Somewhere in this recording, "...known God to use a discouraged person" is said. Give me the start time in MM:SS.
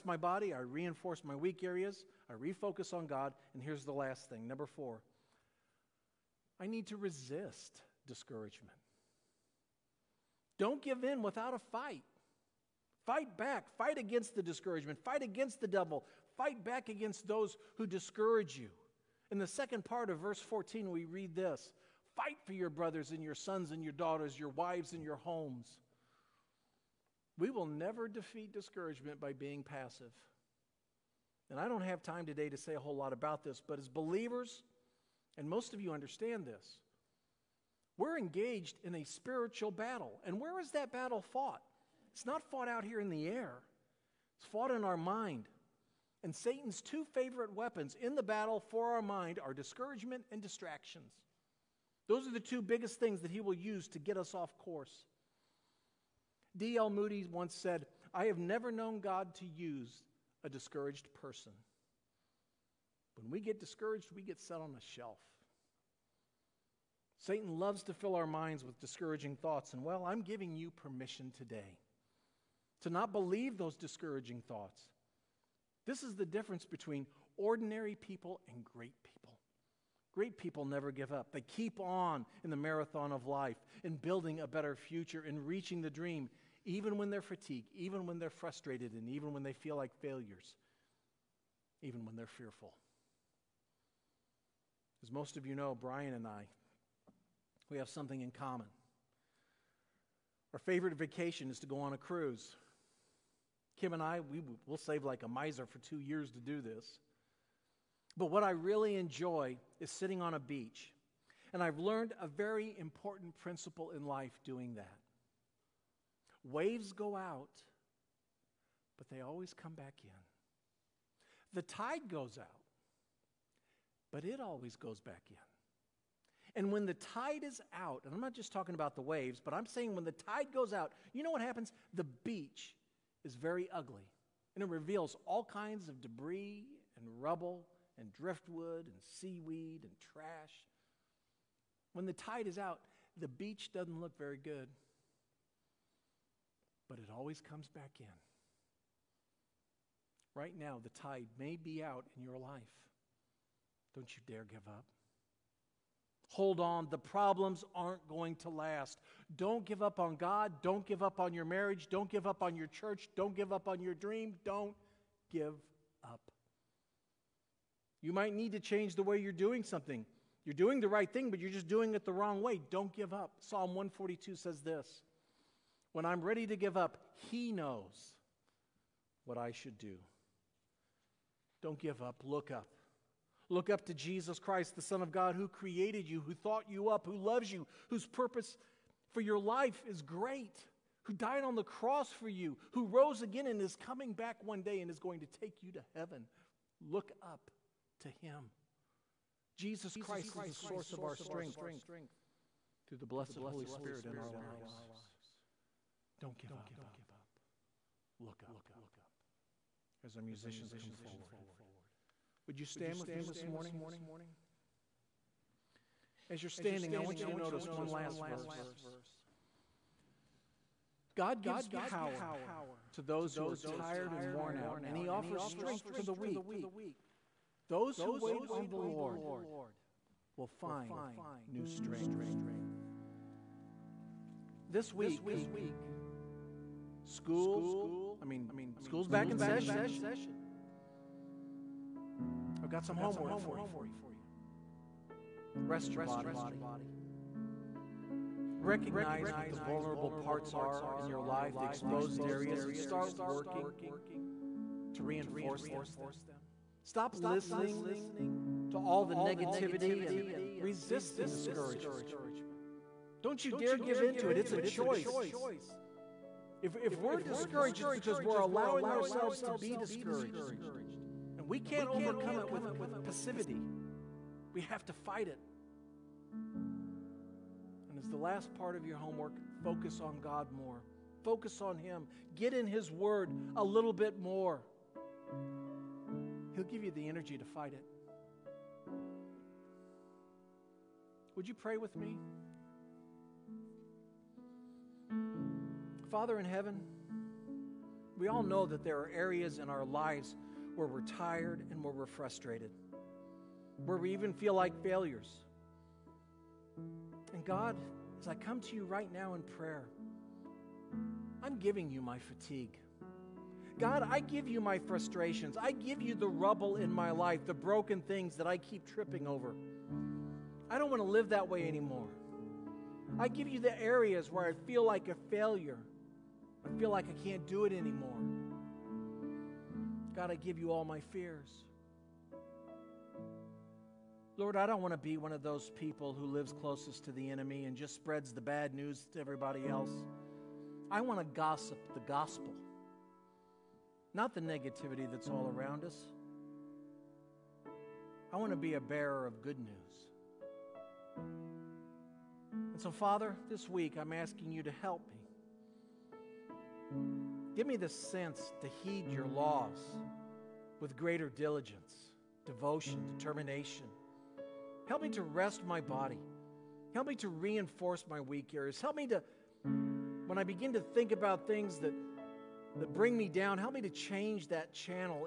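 00:58.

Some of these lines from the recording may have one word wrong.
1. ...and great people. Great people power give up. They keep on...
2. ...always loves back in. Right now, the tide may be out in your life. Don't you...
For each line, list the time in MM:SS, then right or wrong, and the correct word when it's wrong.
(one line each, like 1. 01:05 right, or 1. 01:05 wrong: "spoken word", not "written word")
1. 01:18 wrong: "never", not "power"
2. 02:27 wrong: "comes", not "loves".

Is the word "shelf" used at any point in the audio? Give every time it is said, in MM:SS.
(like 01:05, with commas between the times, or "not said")
01:04.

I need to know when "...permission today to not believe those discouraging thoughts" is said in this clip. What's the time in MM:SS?
01:10.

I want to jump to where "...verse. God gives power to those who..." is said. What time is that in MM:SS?
03:38.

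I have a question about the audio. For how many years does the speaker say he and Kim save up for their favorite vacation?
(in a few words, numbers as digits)
2.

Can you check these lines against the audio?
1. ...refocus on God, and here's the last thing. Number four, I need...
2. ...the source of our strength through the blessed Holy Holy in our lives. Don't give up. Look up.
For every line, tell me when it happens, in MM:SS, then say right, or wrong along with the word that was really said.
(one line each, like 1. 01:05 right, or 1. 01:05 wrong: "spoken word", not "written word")
1. 00:02 right
2. 03:20 wrong: "Spirit", not "Holy".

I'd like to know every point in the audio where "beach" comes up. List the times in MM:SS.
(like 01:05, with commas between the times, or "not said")
01:50, 02:12, 02:23.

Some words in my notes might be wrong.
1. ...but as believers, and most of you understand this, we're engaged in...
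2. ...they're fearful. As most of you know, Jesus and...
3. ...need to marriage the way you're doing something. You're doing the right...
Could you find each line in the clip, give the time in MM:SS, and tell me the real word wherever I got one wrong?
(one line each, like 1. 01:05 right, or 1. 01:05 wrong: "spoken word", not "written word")
1. 00:33 right
2. 01:32 wrong: "Brian", not "Jesus"
3. 02:48 wrong: "change", not "marriage".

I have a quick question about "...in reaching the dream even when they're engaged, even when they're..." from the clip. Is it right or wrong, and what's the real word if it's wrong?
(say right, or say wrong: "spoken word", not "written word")
wrong: "fatigued", not "engaged".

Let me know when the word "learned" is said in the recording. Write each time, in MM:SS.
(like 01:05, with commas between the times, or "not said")
01:51.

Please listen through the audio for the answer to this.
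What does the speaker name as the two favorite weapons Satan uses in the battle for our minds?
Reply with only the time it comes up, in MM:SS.
00:49.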